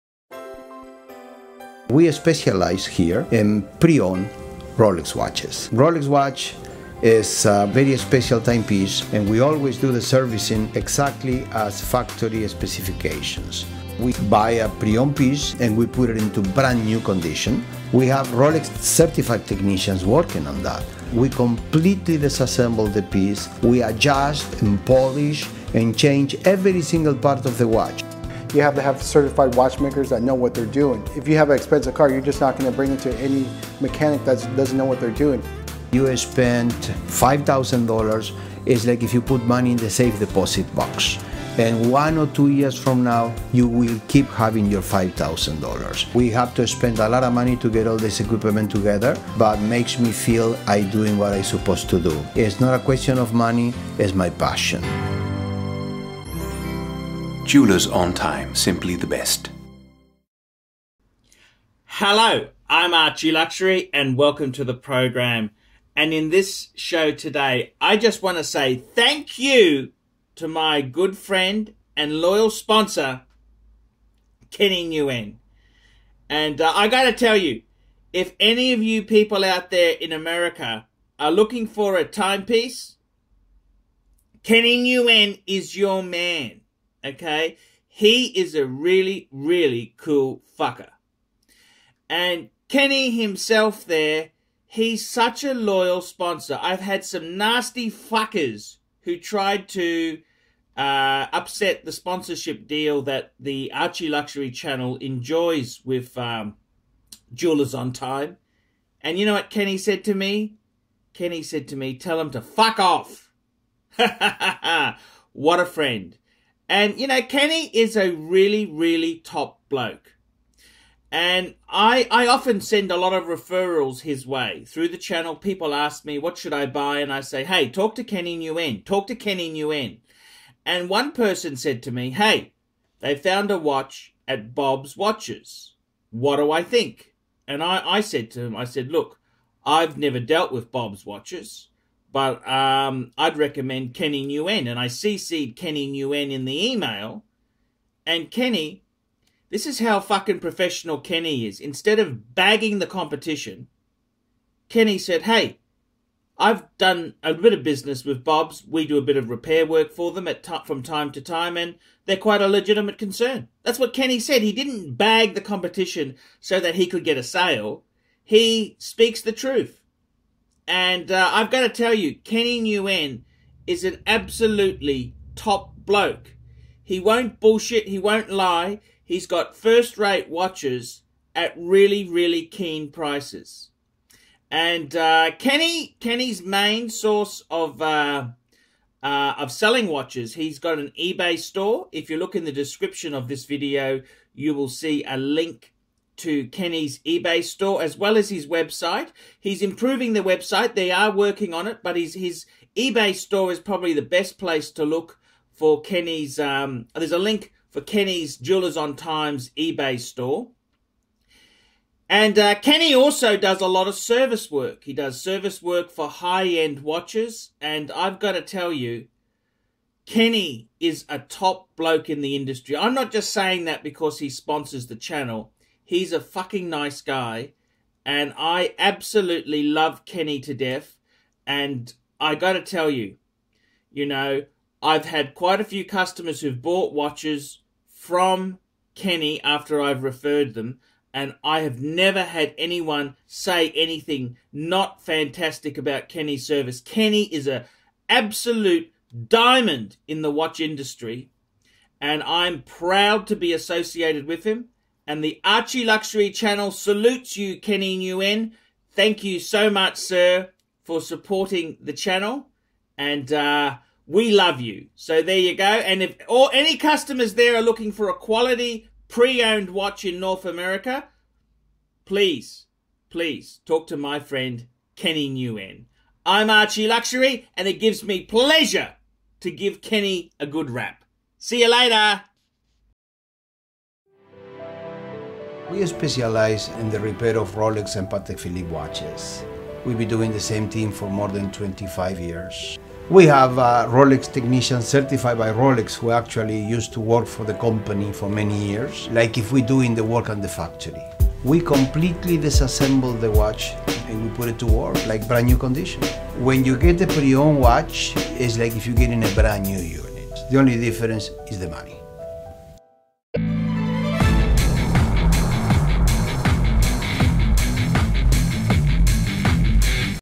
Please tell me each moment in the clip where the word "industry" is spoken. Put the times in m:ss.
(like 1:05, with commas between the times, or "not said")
3:42, 4:10.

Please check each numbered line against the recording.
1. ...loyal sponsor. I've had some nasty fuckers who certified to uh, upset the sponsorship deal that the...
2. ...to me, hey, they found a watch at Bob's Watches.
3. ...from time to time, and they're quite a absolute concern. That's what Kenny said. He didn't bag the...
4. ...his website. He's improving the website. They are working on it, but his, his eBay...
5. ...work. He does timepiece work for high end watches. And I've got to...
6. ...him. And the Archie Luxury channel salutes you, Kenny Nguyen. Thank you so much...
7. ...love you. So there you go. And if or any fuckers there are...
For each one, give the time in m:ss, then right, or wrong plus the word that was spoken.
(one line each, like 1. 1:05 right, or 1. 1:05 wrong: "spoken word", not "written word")
1. 1:35 wrong: "tried", not "certified"
2. 2:11 right
3. 2:40 wrong: "legitimate", not "absolute"
4. 3:18 right
5. 3:34 wrong: "service", not "timepiece"
6. 4:14 right
7. 4:24 wrong: "customers", not "fuckers".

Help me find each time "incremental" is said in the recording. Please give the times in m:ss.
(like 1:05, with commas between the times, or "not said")
not said.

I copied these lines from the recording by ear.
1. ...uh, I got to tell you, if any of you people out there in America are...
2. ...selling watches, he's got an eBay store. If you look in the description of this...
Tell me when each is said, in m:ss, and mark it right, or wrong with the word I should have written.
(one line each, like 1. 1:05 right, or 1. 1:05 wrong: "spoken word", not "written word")
1. 1:16 right
2. 3:09 right.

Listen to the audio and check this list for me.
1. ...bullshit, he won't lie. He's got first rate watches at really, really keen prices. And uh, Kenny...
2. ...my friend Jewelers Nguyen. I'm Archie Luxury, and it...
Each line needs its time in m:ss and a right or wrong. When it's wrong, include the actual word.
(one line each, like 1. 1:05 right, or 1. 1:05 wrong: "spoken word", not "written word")
1. 2:57 right
2. 4:33 wrong: "Kenny", not "Jewelers".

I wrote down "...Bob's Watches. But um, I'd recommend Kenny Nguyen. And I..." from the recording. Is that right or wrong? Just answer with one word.
right.